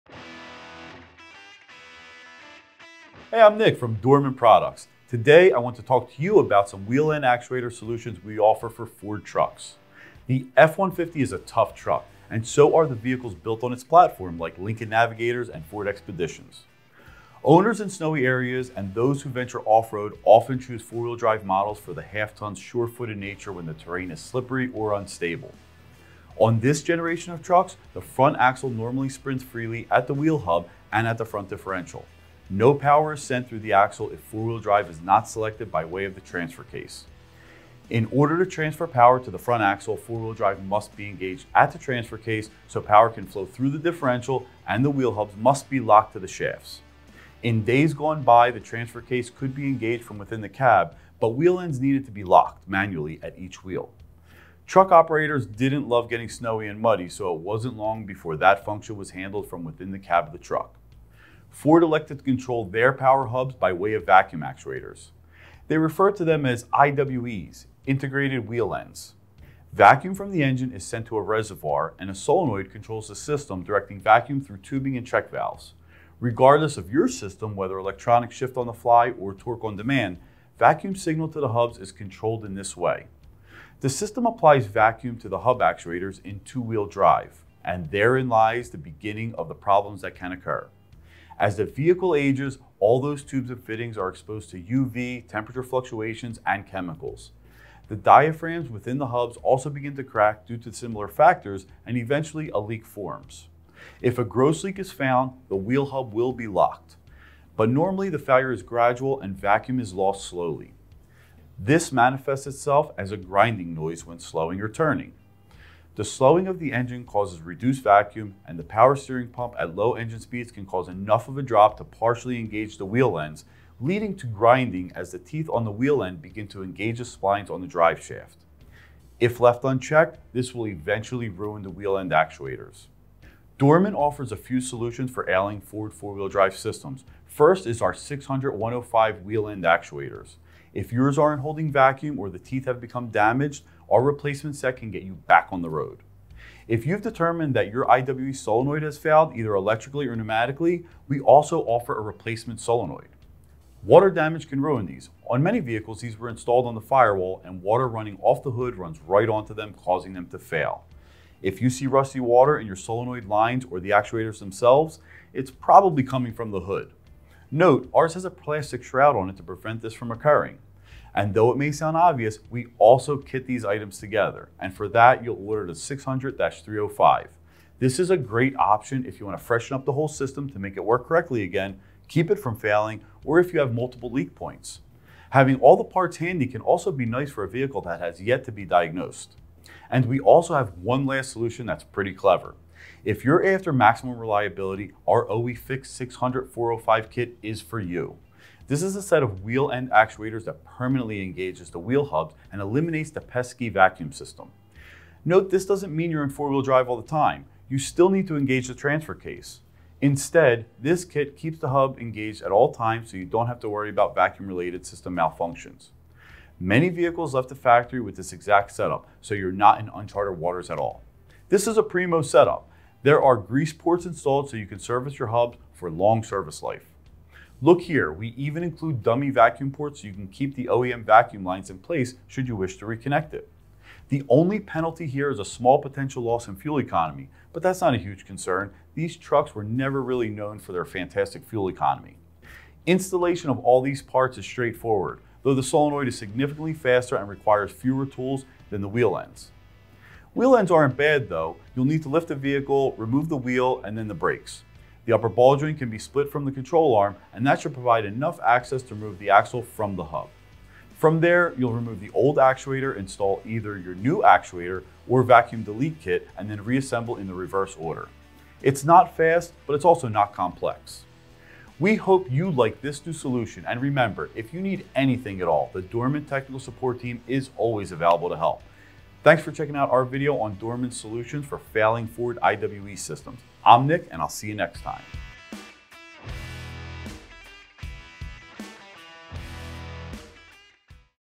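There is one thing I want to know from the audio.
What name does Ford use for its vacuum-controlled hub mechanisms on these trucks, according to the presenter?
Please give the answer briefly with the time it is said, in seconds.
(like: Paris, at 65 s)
integrated wheel ends, at 67 s.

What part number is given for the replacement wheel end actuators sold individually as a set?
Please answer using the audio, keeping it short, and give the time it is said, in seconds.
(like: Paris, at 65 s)
600-105, at 137 s.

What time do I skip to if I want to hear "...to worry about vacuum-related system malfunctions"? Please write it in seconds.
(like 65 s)
213 s.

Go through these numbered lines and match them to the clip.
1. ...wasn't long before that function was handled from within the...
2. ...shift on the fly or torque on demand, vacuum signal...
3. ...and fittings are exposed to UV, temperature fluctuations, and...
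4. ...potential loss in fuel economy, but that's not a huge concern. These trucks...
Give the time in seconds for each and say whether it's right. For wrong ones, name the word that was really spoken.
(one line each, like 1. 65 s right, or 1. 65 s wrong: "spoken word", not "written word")
1. 57 s right
2. 78 s right
3. 93 s right
4. 235 s right.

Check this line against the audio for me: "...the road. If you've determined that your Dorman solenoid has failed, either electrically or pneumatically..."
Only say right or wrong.
wrong.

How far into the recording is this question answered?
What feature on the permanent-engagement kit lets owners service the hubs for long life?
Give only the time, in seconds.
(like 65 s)
223 s.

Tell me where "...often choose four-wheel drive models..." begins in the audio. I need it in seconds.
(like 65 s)
20 s.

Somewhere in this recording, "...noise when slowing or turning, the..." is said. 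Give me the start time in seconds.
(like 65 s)
113 s.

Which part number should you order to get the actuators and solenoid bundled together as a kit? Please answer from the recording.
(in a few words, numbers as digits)
600-305.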